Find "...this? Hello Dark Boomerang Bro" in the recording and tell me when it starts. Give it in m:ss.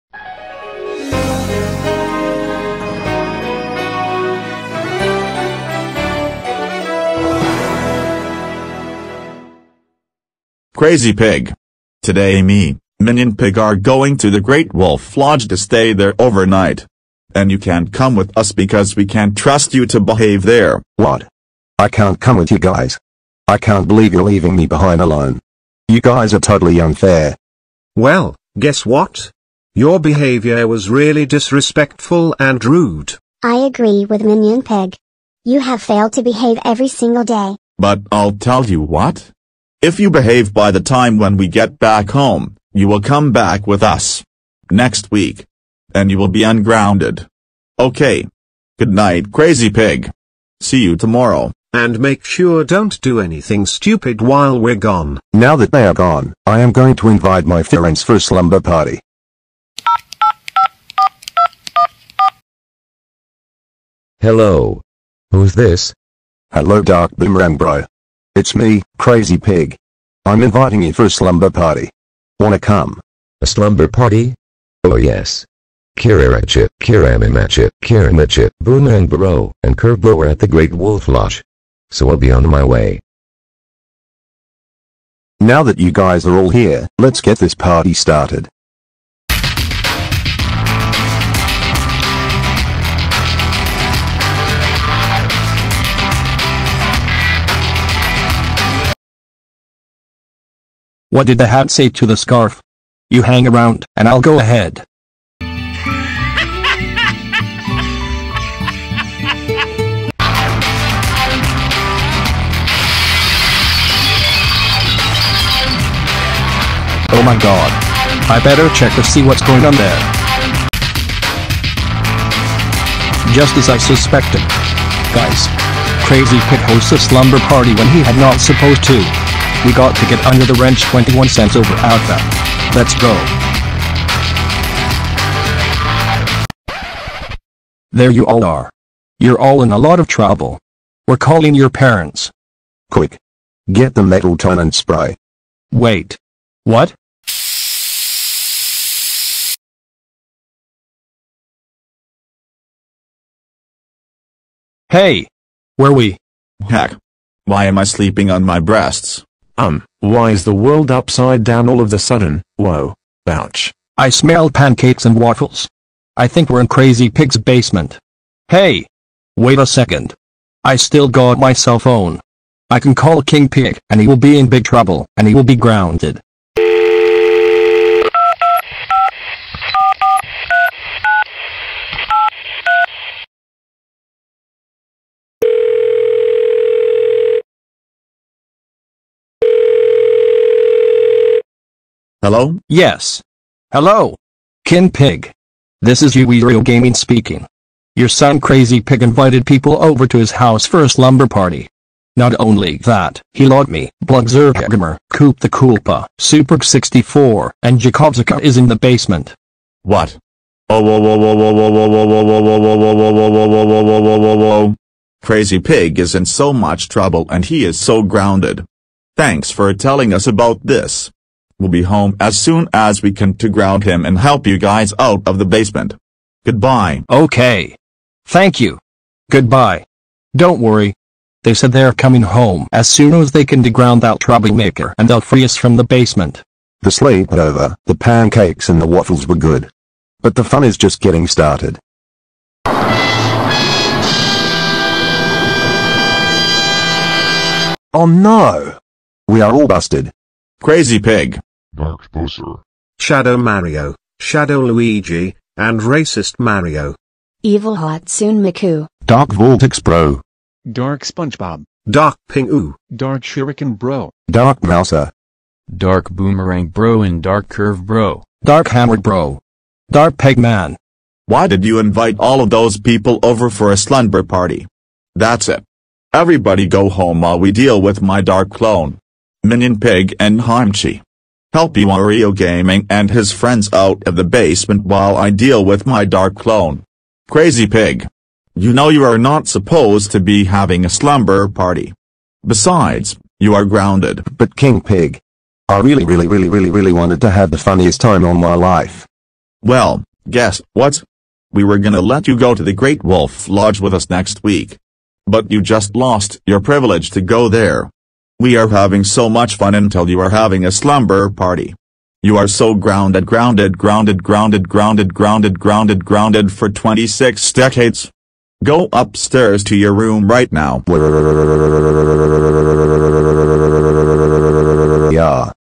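1:05.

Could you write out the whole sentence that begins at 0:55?
Now that they are gone, I am going to invite my friends for slumber party.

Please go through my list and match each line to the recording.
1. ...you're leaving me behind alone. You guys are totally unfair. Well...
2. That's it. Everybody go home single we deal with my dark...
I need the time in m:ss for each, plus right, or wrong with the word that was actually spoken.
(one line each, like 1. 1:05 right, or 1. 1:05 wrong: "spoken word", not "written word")
1. 0:24 right
2. 4:35 wrong: "while", not "single".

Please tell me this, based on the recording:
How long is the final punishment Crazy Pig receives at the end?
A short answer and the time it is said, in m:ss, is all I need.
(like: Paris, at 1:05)
26 decades, at 5:16.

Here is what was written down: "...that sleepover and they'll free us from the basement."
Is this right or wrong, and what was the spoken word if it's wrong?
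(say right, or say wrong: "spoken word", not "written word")
wrong: "troublemaker", not "sleepover".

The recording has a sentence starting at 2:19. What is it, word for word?
You're all in a lot of trouble.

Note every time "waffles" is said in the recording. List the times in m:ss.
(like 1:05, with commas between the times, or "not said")
2:45, 3:58.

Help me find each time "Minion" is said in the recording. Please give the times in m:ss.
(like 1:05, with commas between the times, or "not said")
0:12, 0:34, 4:39.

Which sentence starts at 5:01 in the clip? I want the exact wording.
We were gonna let you go to the Great Wolf Lodge with us next week.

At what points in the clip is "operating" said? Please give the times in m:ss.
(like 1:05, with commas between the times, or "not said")
not said.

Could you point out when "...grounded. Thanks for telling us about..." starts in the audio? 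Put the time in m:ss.
3:38.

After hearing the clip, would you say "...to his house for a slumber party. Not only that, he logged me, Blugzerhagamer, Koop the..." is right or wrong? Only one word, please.
right.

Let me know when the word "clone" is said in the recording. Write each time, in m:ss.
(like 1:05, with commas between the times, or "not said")
4:38, 4:46.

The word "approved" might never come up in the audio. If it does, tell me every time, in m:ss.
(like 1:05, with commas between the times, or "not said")
not said.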